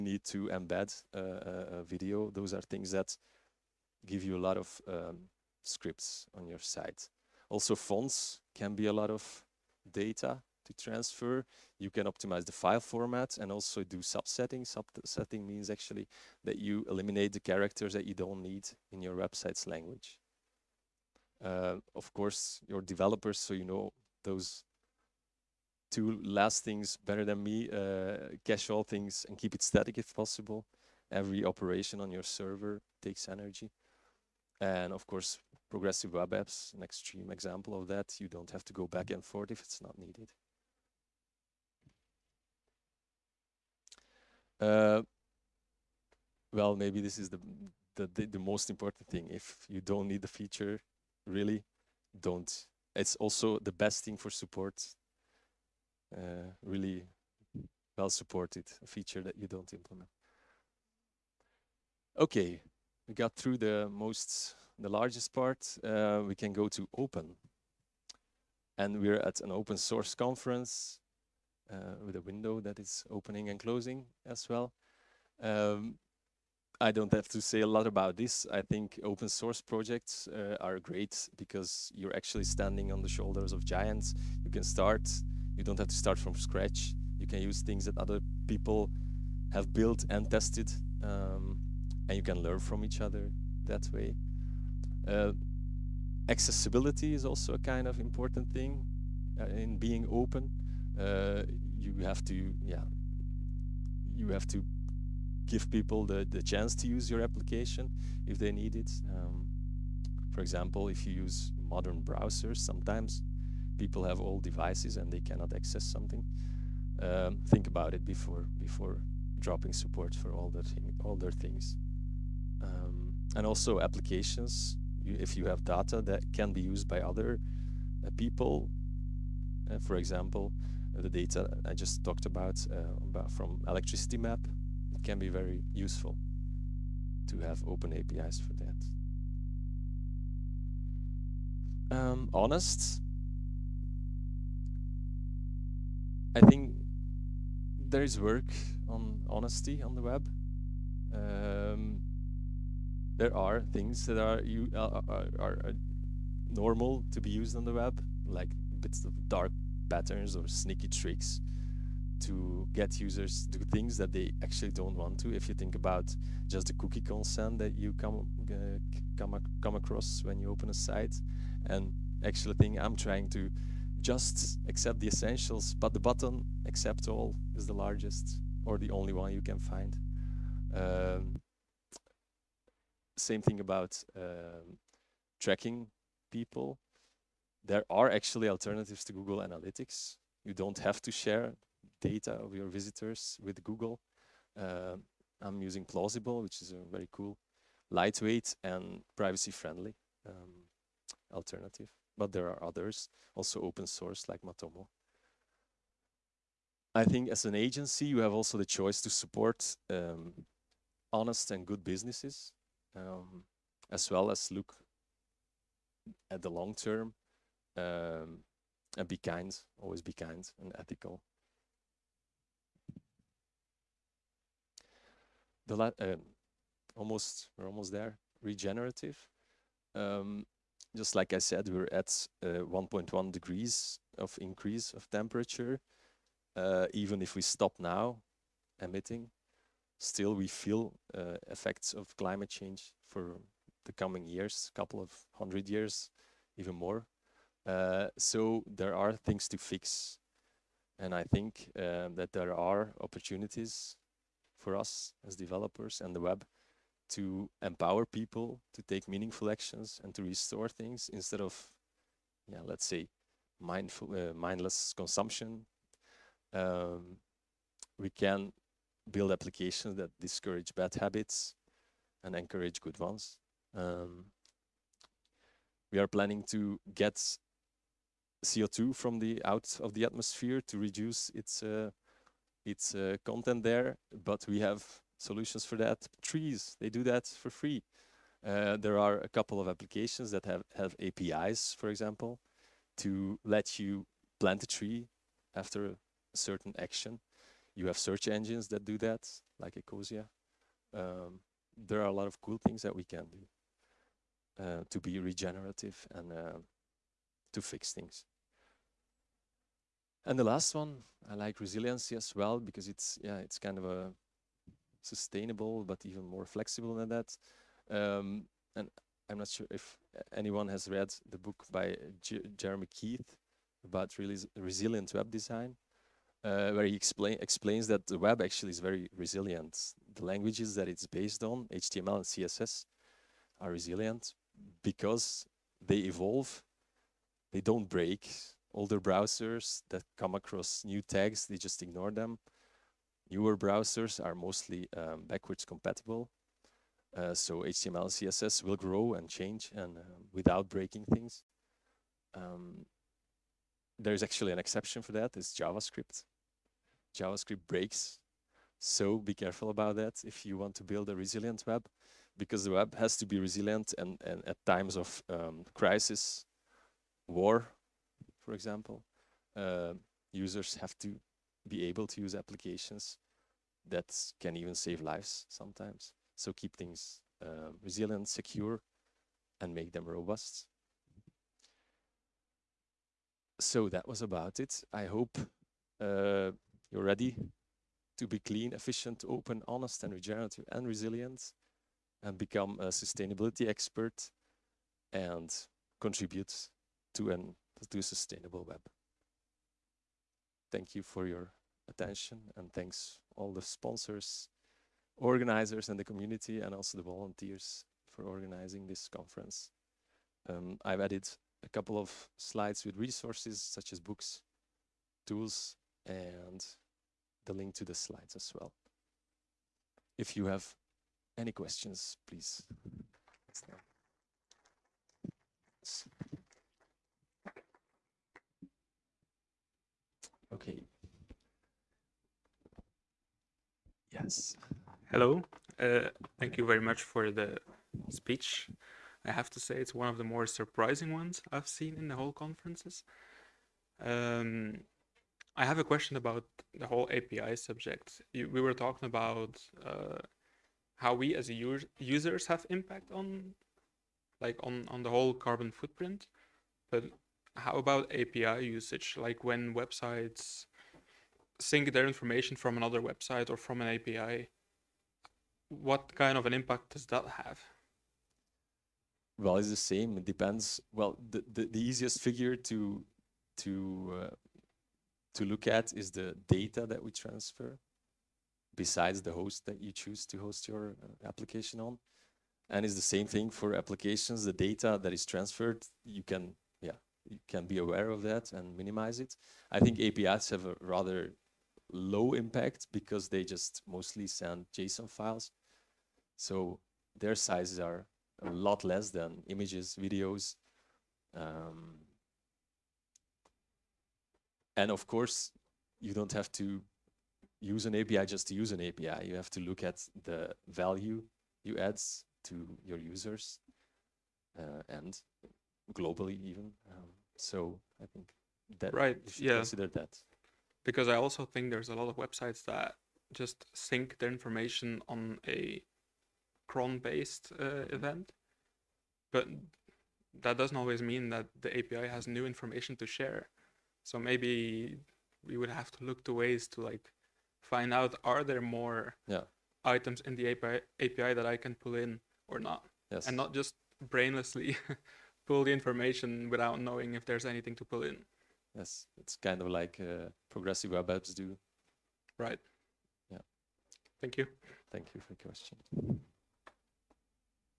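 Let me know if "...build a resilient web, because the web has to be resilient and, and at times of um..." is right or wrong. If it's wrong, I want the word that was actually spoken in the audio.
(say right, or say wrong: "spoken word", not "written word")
right.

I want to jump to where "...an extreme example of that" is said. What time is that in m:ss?
0:36.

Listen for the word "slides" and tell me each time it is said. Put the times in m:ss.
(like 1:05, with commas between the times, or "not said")
6:52, 6:57.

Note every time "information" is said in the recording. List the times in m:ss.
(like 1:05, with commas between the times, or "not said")
7:42, 8:44, 8:52, 9:05.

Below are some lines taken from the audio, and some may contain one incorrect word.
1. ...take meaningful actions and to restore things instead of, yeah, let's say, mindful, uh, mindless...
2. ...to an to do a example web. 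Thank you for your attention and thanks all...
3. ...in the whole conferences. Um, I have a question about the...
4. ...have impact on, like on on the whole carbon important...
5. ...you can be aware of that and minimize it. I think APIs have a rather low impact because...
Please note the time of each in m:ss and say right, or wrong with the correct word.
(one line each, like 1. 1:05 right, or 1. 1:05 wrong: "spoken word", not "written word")
1. 4:18 right
2. 6:37 wrong: "sustainable", not "example"
3. 7:22 right
4. 7:32 wrong: "footprint", not "important"
5. 8:07 right.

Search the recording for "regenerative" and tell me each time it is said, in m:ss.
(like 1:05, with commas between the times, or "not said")
3:48, 5:05, 6:30.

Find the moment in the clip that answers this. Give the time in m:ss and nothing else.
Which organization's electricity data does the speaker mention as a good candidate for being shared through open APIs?
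2:13.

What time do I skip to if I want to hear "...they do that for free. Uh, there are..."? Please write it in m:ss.
4:46.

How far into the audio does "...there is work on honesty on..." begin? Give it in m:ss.
2:27.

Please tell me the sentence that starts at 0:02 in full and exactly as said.
Those are things that give you a lot of um, scripts on your site.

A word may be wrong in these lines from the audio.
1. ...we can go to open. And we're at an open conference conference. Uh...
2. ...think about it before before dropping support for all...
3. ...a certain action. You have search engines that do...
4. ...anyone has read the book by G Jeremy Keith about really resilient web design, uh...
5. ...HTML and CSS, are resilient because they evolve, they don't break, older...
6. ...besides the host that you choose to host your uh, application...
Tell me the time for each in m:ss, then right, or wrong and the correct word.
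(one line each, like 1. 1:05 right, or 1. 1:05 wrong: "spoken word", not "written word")
1. 1:06 wrong: "source", not "conference"
2. 1:57 right
3. 4:55 right
4. 5:20 right
5. 5:31 right
6. 7:58 right.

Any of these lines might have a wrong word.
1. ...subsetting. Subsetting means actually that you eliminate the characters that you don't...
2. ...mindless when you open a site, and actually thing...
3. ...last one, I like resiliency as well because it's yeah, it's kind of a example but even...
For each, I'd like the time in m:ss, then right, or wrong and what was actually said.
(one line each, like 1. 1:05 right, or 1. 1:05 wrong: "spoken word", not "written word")
1. 0:13 right
2. 2:49 wrong: "across", not "mindless"
3. 5:10 wrong: "sustainable", not "example".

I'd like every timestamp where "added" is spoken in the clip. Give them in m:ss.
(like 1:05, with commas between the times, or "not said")
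6:51.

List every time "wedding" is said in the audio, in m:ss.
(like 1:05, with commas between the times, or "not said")
not said.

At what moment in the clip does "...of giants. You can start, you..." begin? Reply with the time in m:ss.
1:23.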